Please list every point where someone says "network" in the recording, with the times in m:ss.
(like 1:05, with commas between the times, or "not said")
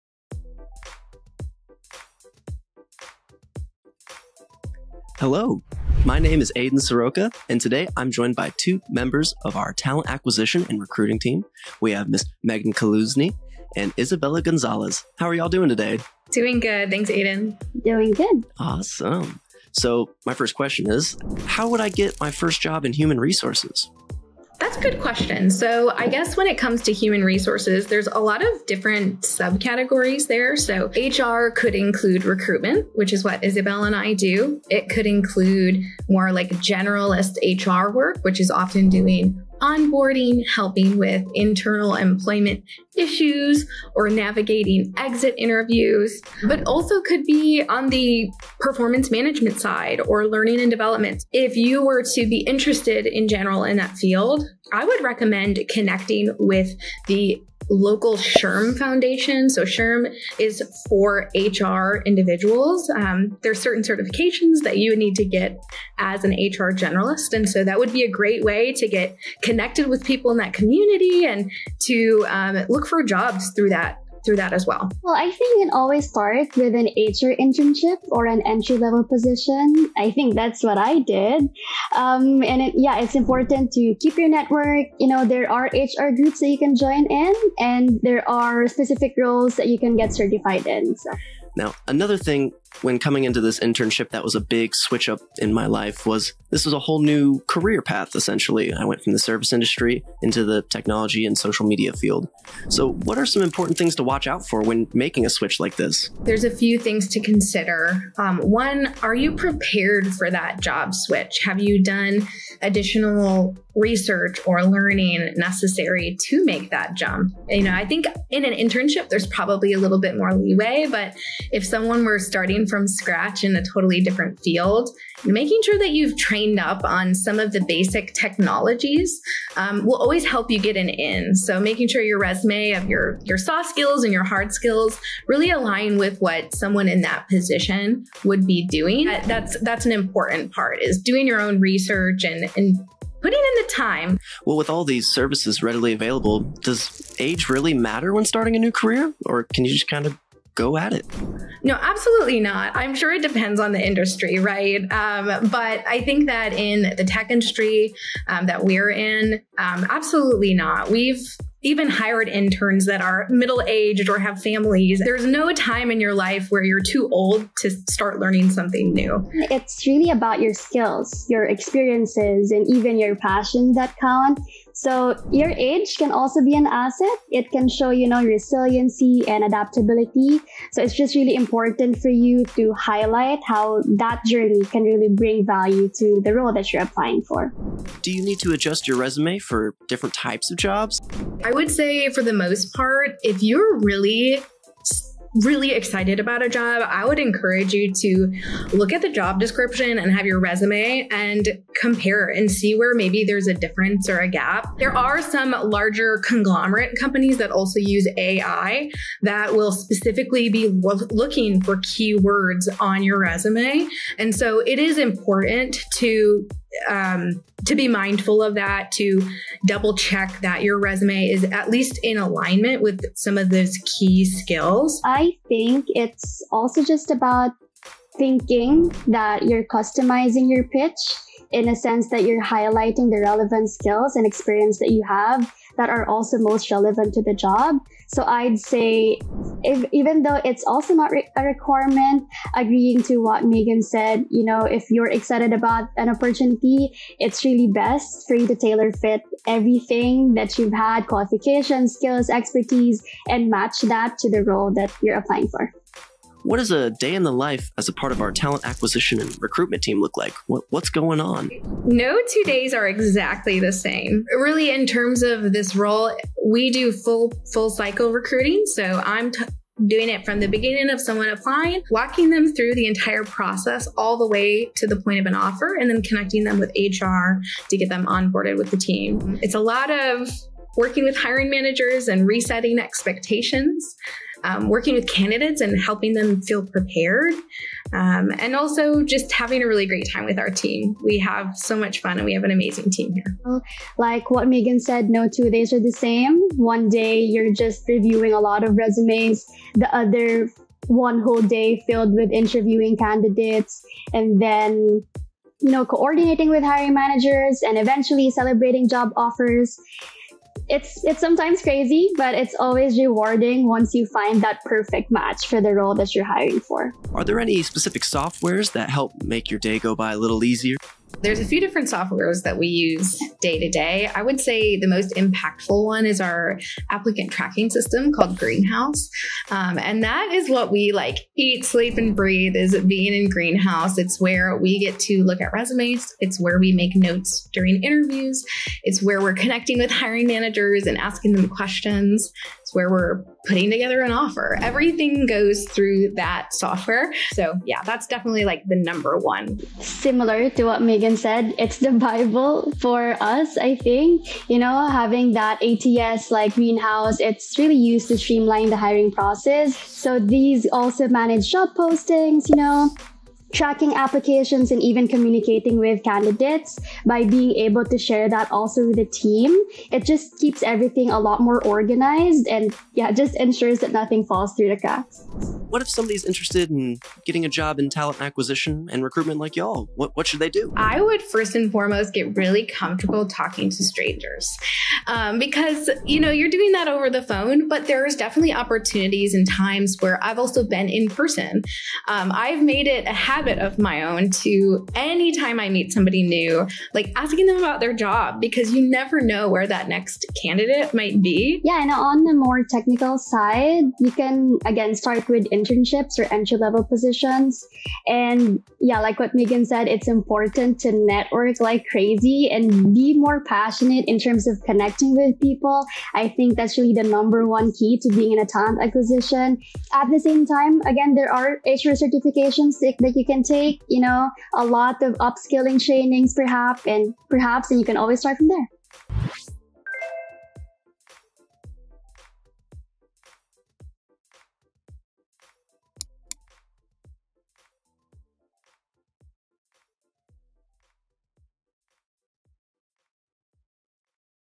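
1:24, 6:50.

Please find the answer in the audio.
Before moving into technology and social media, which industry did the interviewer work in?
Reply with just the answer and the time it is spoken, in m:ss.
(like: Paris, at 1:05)
Service industry, at 1:39.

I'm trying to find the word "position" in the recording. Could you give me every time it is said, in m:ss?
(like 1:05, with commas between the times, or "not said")
1:19, 2:17, 6:46.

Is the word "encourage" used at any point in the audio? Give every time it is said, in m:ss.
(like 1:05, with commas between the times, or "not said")
3:17.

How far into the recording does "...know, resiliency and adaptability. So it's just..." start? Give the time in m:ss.
2:58.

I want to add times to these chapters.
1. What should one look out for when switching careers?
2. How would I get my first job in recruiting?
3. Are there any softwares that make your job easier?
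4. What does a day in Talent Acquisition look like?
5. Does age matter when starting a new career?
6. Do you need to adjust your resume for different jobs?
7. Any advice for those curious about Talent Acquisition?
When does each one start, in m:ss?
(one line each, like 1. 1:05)
1. 1:42
2. 0:21
3. 5:17
4. 4:18
5. 2:26
6. 3:07
7. 6:15.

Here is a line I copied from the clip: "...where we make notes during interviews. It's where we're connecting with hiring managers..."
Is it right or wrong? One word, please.
right.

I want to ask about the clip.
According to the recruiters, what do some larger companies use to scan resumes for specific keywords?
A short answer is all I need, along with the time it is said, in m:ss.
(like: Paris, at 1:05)
AI, at 3:28.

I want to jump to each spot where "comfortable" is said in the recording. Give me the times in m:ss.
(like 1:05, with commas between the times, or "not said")
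6:22.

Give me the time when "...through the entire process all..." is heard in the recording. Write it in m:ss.
4:32.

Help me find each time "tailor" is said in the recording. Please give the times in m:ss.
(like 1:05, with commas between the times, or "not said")
4:08.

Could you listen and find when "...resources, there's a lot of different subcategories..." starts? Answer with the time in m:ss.
0:27.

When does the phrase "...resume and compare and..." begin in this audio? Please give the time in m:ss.
3:20.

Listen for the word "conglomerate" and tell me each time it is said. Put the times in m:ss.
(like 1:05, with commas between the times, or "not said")
3:26.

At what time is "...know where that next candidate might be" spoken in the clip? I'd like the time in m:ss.
6:39.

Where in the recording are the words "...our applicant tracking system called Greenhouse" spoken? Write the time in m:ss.
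5:26.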